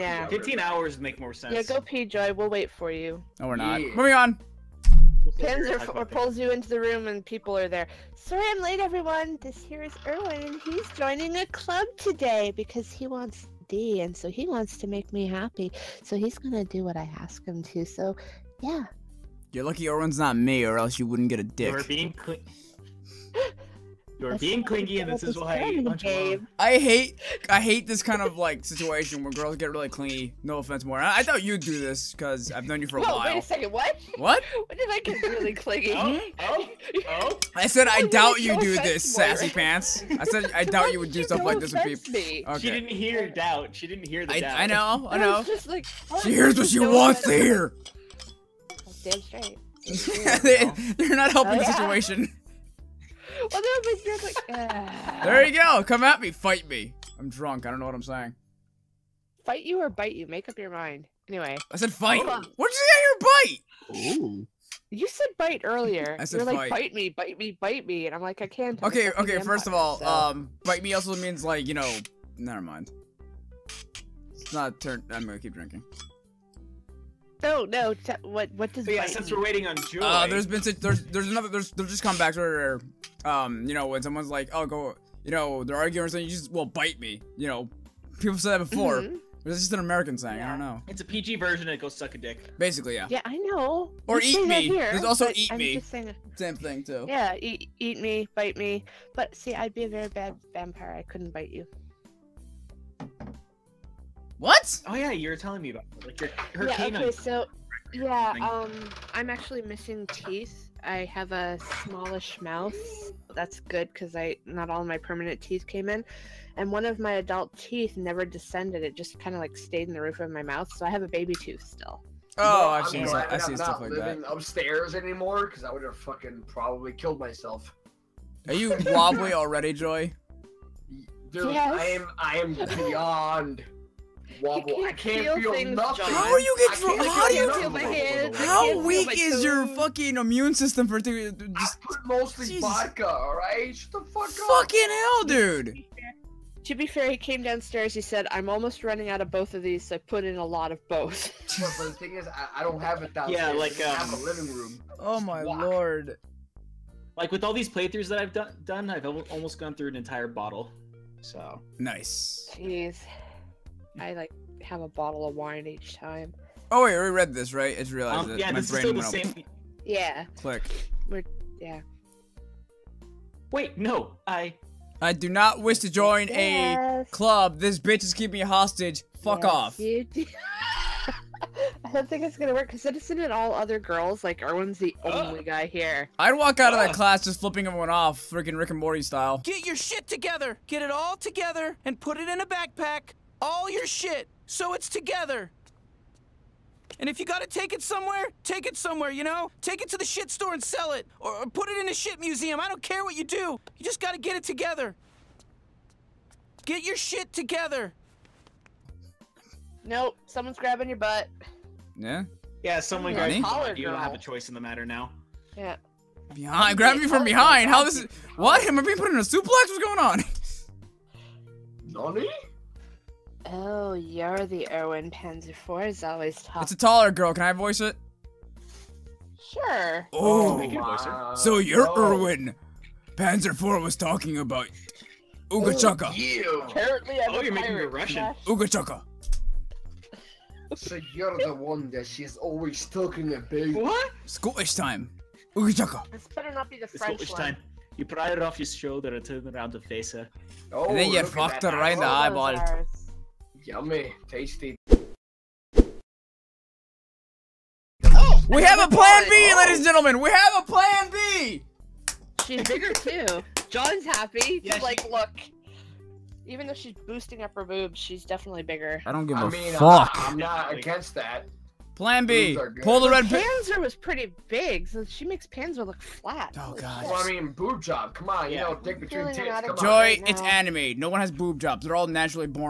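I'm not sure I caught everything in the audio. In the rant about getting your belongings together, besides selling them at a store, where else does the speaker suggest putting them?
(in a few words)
a shit museum.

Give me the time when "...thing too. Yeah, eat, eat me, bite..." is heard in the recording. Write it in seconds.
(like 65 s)
96 s.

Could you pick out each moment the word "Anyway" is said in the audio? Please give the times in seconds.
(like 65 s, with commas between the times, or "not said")
61 s.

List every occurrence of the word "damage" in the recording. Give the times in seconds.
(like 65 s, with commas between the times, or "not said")
not said.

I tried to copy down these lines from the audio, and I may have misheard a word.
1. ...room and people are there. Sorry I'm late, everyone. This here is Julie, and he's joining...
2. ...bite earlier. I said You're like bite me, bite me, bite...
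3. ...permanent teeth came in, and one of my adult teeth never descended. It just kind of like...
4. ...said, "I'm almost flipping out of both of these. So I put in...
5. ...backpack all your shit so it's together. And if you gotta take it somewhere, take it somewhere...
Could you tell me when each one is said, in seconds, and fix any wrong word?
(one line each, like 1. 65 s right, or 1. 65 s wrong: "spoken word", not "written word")
1. 6 s wrong: "Erwin", not "Julie"
2. 65 s right
3. 114 s right
4. 148 s wrong: "running", not "flipping"
5. 192 s right.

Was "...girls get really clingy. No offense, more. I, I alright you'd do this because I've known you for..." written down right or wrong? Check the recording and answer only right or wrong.
wrong.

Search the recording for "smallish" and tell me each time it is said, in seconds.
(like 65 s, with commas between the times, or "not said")
111 s.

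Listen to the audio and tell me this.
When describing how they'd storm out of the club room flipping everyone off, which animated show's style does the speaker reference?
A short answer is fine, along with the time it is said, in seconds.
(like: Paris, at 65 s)
Rick and Morty, at 188 s.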